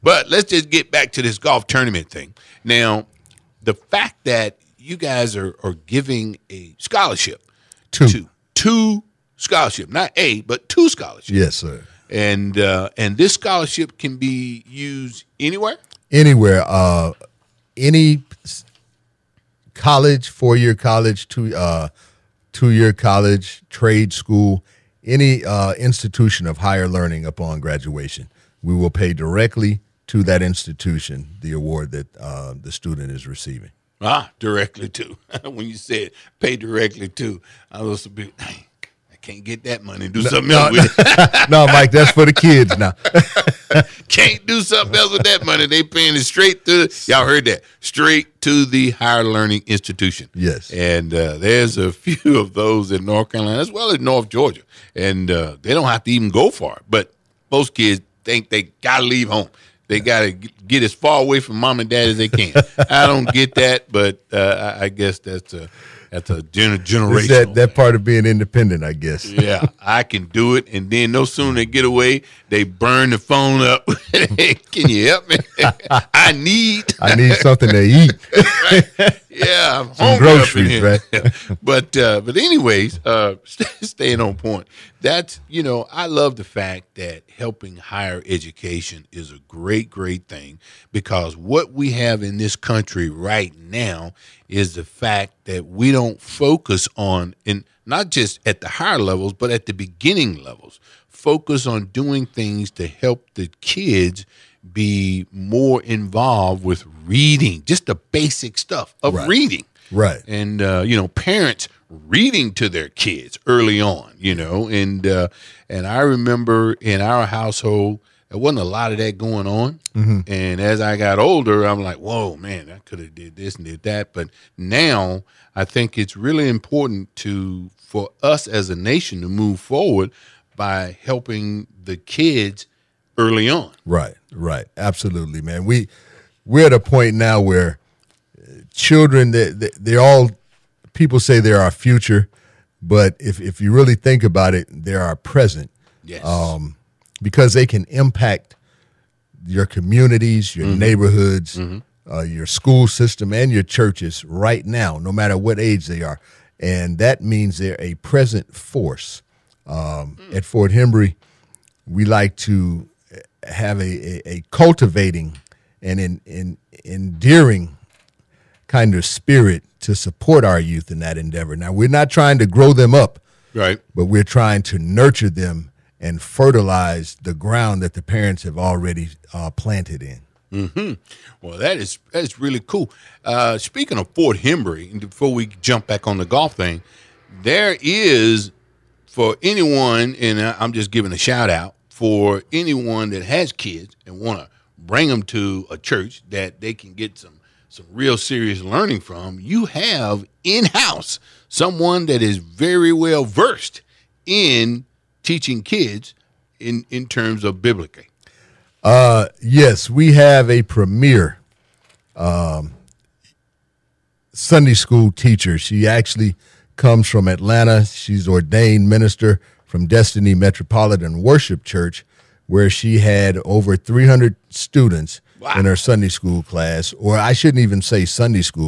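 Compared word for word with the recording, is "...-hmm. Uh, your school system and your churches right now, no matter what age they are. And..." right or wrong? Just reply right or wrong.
right.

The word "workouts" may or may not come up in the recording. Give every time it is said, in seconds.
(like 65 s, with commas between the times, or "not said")
not said.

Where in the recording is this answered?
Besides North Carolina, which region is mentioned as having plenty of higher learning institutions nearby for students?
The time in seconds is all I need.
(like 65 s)
53 s.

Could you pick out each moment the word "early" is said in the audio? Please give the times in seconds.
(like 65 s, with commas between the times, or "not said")
113 s, 133 s.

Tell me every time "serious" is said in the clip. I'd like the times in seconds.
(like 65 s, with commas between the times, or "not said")
198 s.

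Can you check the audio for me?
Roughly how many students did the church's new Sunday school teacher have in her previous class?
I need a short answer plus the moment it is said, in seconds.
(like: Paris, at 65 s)
Over 300, at 223 s.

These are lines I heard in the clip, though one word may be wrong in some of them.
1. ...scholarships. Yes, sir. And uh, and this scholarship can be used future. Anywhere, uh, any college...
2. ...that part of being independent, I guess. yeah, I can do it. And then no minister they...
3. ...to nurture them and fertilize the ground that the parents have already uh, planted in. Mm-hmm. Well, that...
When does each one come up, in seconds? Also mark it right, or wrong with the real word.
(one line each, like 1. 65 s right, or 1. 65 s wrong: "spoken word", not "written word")
1. 10 s wrong: "anywhere", not "future"
2. 67 s wrong: "sooner", not "minister"
3. 174 s right.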